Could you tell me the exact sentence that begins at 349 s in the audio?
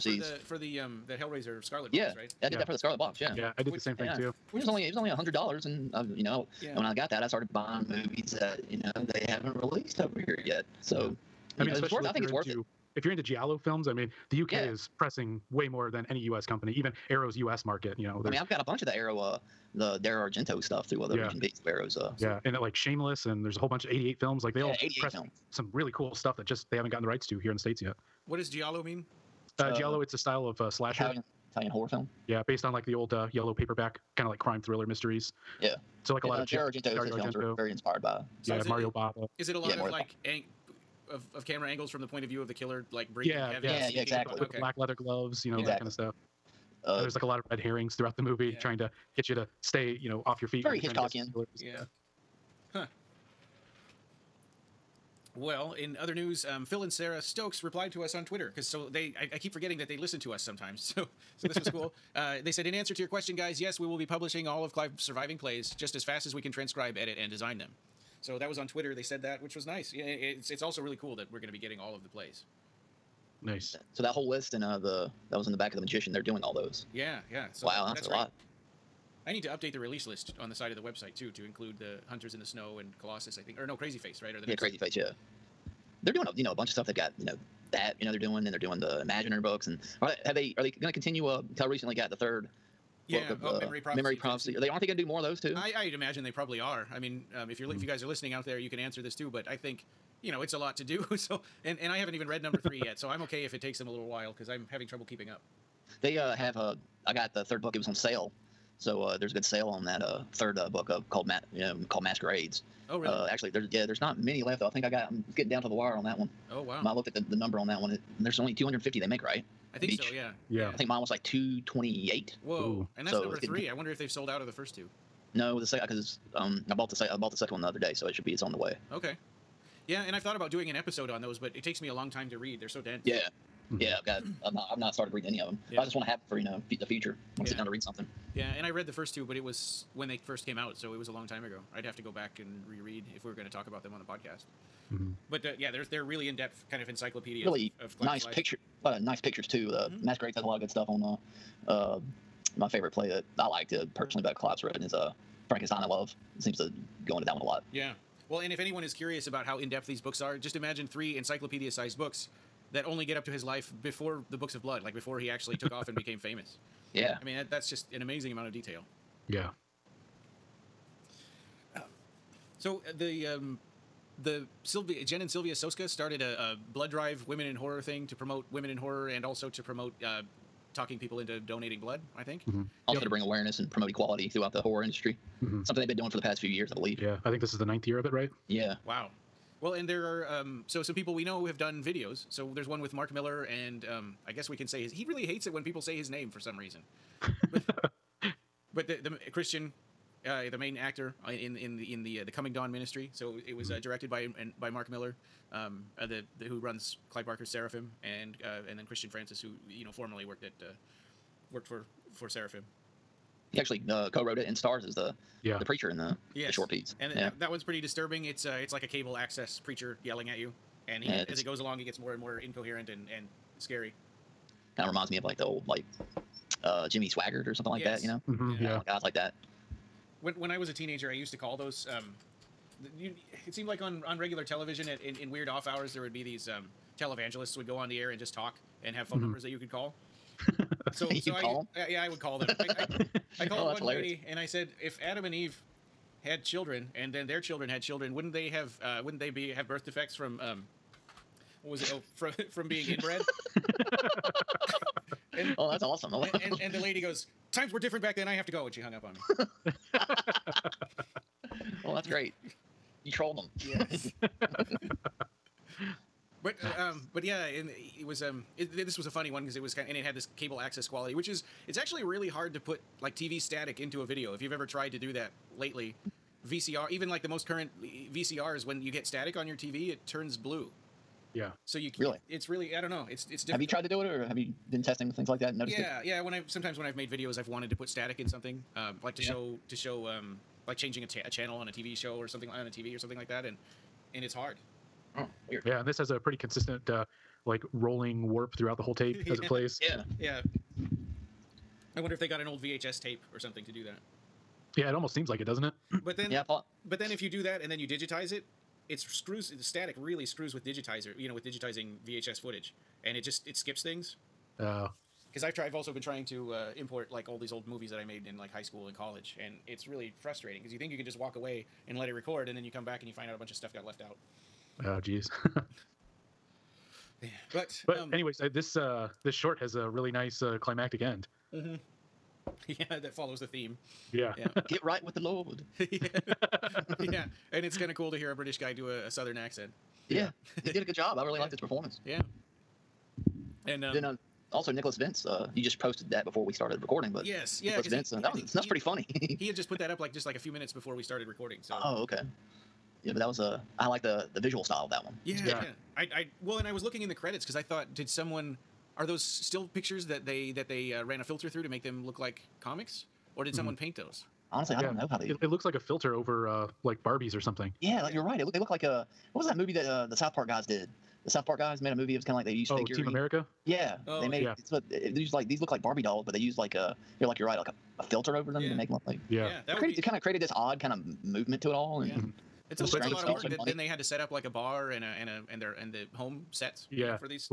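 he had just put that up like just like a few minutes before we started recording.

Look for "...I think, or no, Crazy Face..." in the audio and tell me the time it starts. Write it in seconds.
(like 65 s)
83 s.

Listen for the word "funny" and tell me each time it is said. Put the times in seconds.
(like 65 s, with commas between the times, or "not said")
269 s, 348 s.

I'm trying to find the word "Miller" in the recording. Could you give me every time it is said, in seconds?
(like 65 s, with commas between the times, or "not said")
193 s, 204 s.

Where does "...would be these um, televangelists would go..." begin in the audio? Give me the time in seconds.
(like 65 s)
236 s.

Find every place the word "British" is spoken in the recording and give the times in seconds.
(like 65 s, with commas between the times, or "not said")
338 s.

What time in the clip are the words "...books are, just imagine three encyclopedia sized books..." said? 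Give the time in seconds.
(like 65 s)
160 s.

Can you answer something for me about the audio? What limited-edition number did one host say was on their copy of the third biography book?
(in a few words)
228.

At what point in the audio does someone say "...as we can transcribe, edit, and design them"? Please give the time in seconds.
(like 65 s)
66 s.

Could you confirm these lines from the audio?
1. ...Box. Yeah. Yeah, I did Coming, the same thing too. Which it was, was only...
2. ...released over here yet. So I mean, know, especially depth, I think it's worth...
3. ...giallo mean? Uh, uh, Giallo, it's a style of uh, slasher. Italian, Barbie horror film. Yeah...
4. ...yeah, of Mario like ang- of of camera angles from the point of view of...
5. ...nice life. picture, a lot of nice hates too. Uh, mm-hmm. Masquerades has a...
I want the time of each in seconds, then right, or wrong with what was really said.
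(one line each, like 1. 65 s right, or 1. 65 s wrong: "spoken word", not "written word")
1. 2 s wrong: "Which", not "Coming"
2. 9 s wrong: "worth", not "depth"
3. 28 s wrong: "Italian", not "Barbie"
4. 39 s right
5. 148 s wrong: "pictures", not "hates".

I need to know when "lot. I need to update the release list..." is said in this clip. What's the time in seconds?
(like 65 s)
78 s.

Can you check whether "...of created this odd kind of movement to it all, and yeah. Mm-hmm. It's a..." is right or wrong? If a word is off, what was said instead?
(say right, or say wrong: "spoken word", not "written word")
right.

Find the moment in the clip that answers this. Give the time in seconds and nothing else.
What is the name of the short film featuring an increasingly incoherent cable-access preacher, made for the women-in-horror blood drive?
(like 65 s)
202 s.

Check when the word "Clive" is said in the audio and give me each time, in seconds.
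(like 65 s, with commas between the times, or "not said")
64 s, 154 s, 207 s.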